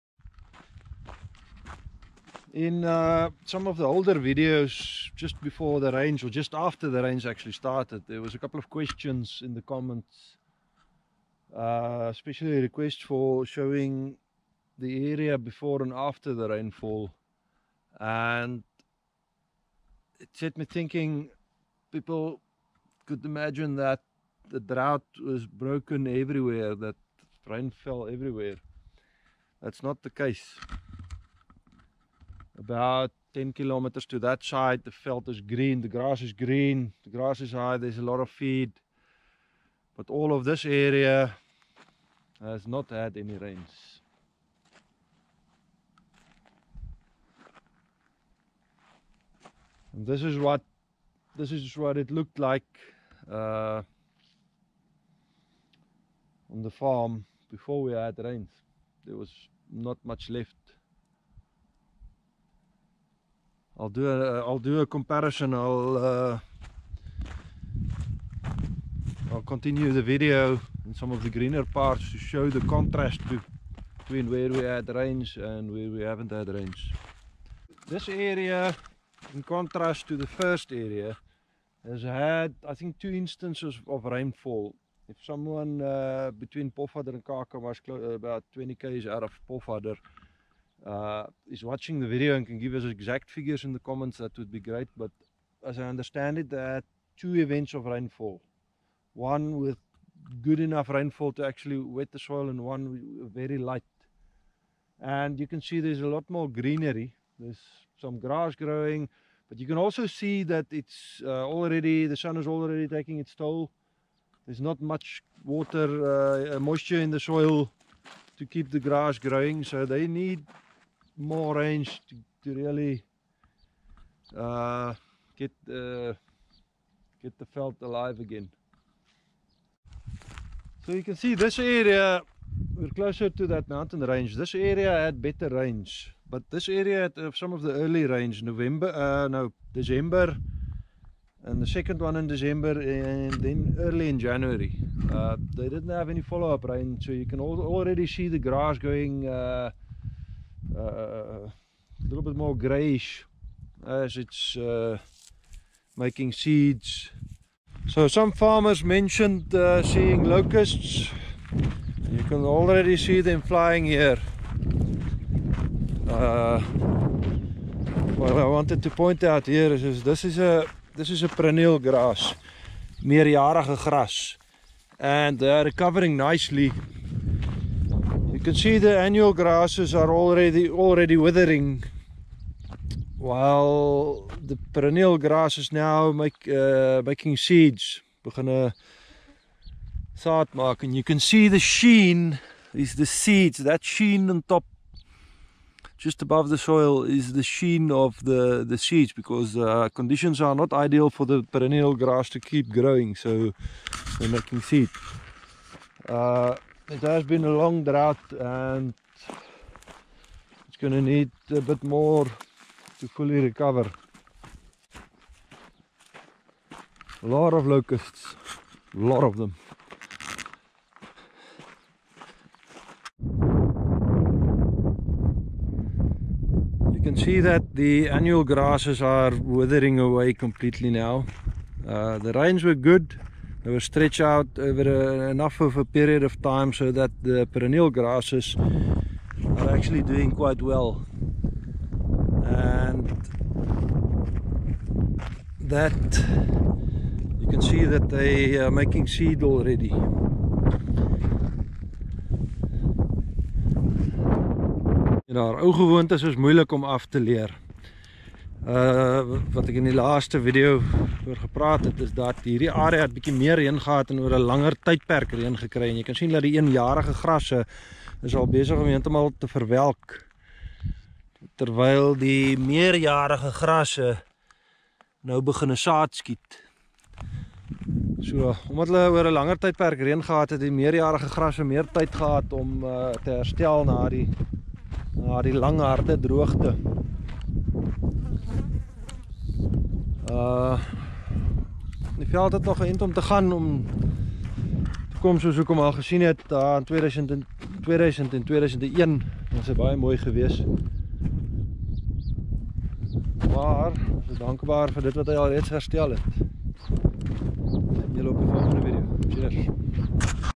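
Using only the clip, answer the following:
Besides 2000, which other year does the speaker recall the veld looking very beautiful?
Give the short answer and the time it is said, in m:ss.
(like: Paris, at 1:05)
2001, at 4:58.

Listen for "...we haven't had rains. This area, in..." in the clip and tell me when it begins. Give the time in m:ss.
1:15.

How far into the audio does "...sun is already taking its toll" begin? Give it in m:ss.
1:52.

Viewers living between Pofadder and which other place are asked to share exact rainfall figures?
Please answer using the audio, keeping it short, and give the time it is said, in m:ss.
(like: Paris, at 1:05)
Kaka, at 1:27.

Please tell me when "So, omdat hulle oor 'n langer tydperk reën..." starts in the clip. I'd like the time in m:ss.
4:38.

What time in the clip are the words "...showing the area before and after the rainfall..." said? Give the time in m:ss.
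0:13.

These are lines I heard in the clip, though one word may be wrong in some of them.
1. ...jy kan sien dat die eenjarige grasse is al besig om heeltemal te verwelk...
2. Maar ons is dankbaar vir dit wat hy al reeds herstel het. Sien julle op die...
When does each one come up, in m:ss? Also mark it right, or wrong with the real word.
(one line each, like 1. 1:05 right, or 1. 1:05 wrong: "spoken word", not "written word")
1. 4:25 right
2. 5:03 right.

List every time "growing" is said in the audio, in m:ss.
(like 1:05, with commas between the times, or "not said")
1:48, 1:59, 3:22.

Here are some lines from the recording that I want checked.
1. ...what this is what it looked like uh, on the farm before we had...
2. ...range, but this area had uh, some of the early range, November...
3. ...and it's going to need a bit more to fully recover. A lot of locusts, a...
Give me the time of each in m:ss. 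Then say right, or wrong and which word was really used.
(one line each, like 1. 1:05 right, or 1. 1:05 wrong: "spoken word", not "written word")
1. 0:50 right
2. 2:15 right
3. 3:28 right.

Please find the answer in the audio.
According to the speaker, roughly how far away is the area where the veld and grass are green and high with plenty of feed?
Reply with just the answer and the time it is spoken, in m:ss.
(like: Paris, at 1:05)
10 kilometers, at 0:33.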